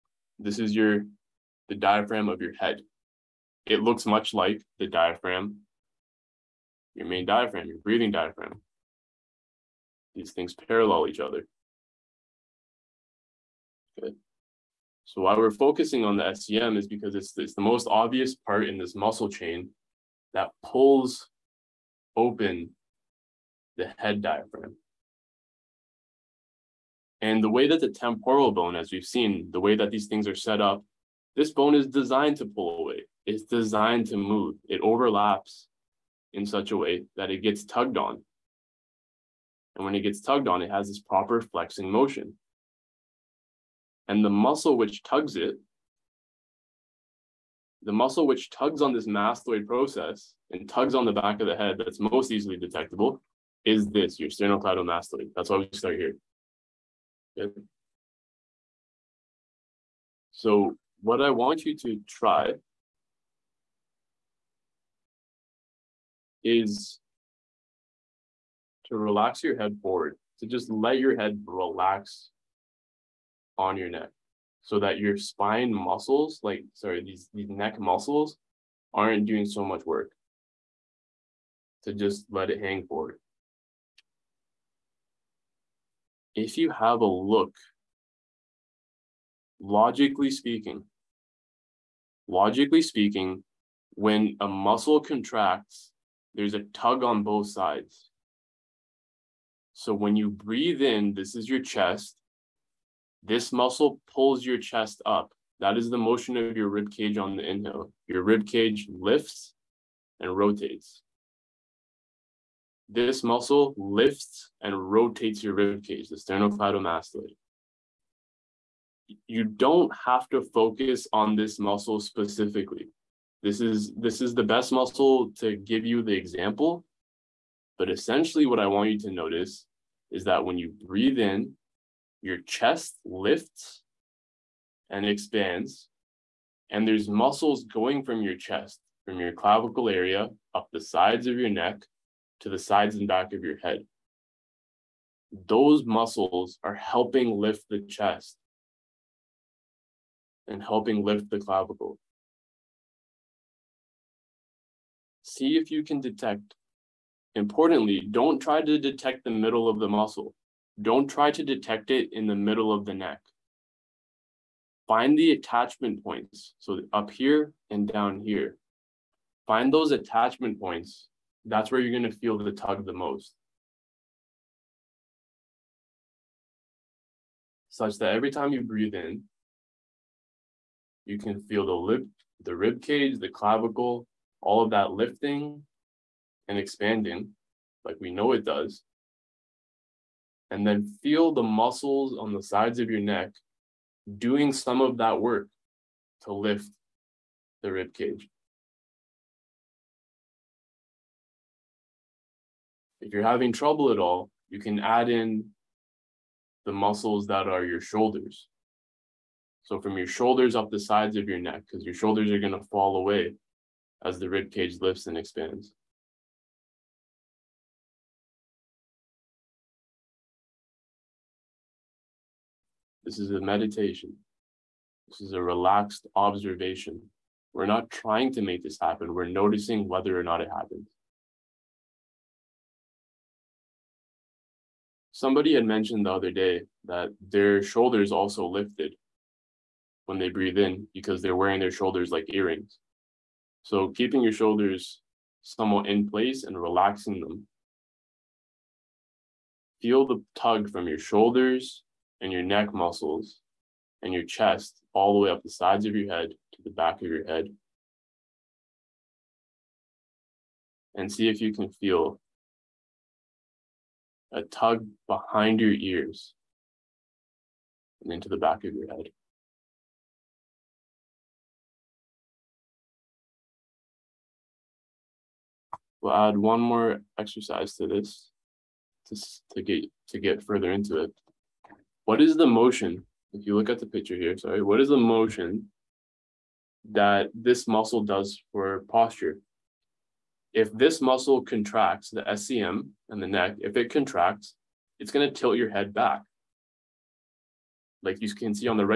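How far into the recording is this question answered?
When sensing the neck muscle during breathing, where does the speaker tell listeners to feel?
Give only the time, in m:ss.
2:45.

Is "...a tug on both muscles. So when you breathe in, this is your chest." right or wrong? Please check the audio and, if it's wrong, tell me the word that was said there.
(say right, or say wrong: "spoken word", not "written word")
wrong: "sides", not "muscles".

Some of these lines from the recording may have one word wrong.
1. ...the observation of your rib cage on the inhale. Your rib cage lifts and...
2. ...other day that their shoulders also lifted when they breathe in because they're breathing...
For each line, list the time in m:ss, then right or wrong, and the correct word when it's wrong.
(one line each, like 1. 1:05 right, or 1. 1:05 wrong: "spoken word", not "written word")
1. 1:45 wrong: "motion", not "observation"
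2. 3:56 wrong: "wearing", not "breathing".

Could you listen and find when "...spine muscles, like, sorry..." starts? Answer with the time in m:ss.
1:15.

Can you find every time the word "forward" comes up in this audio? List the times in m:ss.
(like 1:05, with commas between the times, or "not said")
1:09, 1:22.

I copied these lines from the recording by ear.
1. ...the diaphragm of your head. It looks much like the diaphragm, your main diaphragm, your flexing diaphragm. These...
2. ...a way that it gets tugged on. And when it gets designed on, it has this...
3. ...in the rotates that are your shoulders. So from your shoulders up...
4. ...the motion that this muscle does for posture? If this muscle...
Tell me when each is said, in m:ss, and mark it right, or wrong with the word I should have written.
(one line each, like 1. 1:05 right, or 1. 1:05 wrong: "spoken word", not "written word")
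1. 0:01 wrong: "breathing", not "flexing"
2. 0:36 wrong: "tugged", not "designed"
3. 3:25 wrong: "muscles", not "rotates"
4. 4:44 right.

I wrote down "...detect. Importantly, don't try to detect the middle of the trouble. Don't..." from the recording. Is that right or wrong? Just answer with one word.
wrong.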